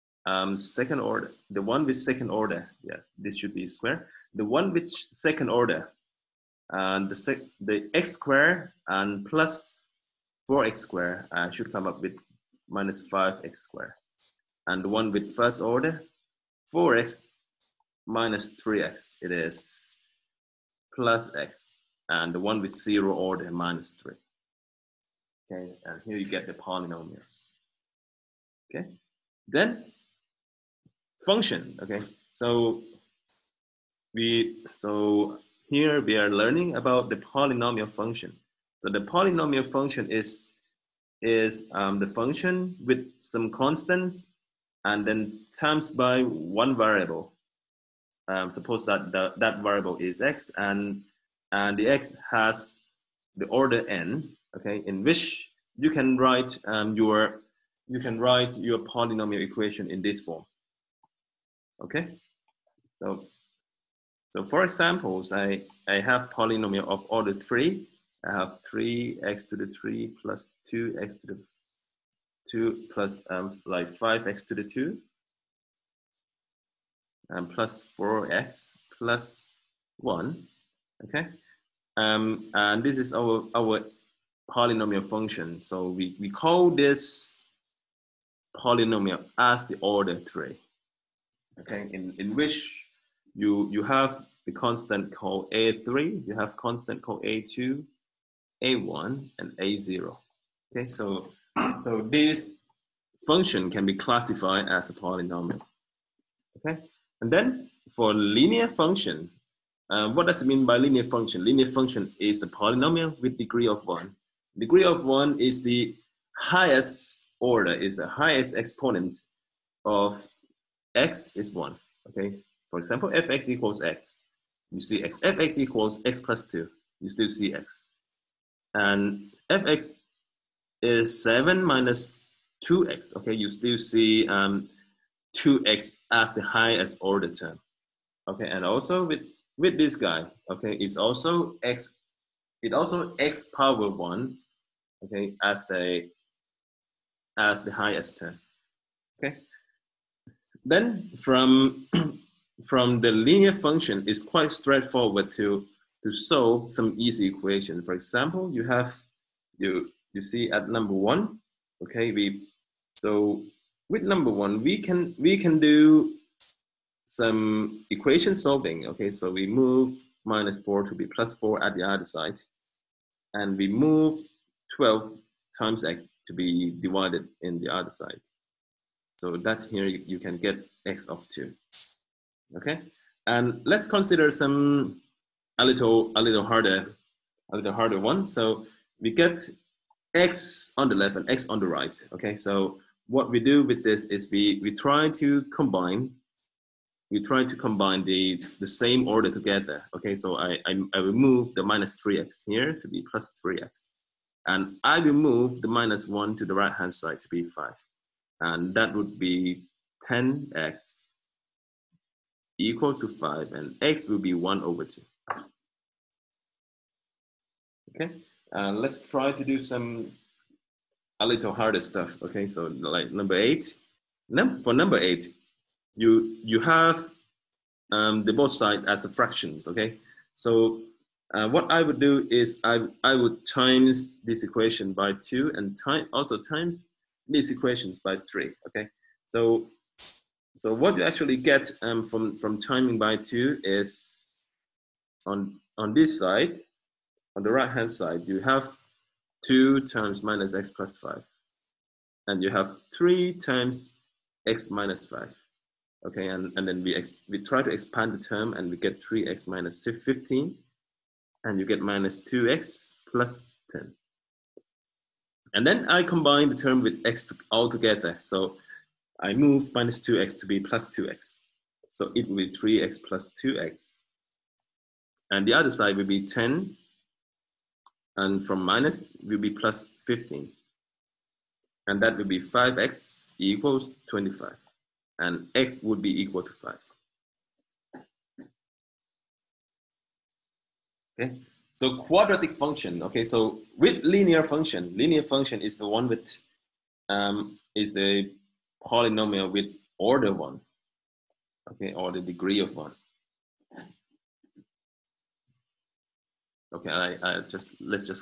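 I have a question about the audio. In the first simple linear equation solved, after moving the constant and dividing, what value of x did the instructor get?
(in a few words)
2.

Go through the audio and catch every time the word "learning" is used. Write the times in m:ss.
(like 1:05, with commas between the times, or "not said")
0:36.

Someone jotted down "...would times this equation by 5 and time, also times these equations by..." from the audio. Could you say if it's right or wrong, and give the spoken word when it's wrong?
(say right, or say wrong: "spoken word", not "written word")
wrong: "2", not "5".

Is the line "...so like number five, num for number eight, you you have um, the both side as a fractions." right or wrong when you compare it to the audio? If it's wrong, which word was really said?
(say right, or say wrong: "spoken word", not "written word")
wrong: "eight", not "five".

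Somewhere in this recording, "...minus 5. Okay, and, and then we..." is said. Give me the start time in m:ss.
4:14.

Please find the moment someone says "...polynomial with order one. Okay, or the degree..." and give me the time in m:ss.
4:58.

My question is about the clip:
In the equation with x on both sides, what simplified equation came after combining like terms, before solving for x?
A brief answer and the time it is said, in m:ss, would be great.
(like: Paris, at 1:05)
10x = 5, at 3:30.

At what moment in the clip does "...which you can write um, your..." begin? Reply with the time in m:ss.
0:55.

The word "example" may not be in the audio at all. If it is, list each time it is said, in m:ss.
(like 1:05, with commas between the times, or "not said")
1:04, 2:02, 2:37.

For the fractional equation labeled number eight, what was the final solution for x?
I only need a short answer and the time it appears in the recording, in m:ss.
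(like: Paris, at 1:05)
5, at 4:45.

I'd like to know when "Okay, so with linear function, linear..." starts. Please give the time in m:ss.
4:53.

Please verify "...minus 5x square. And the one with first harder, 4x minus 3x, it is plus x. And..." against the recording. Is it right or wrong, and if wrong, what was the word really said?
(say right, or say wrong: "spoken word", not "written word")
wrong: "order", not "harder".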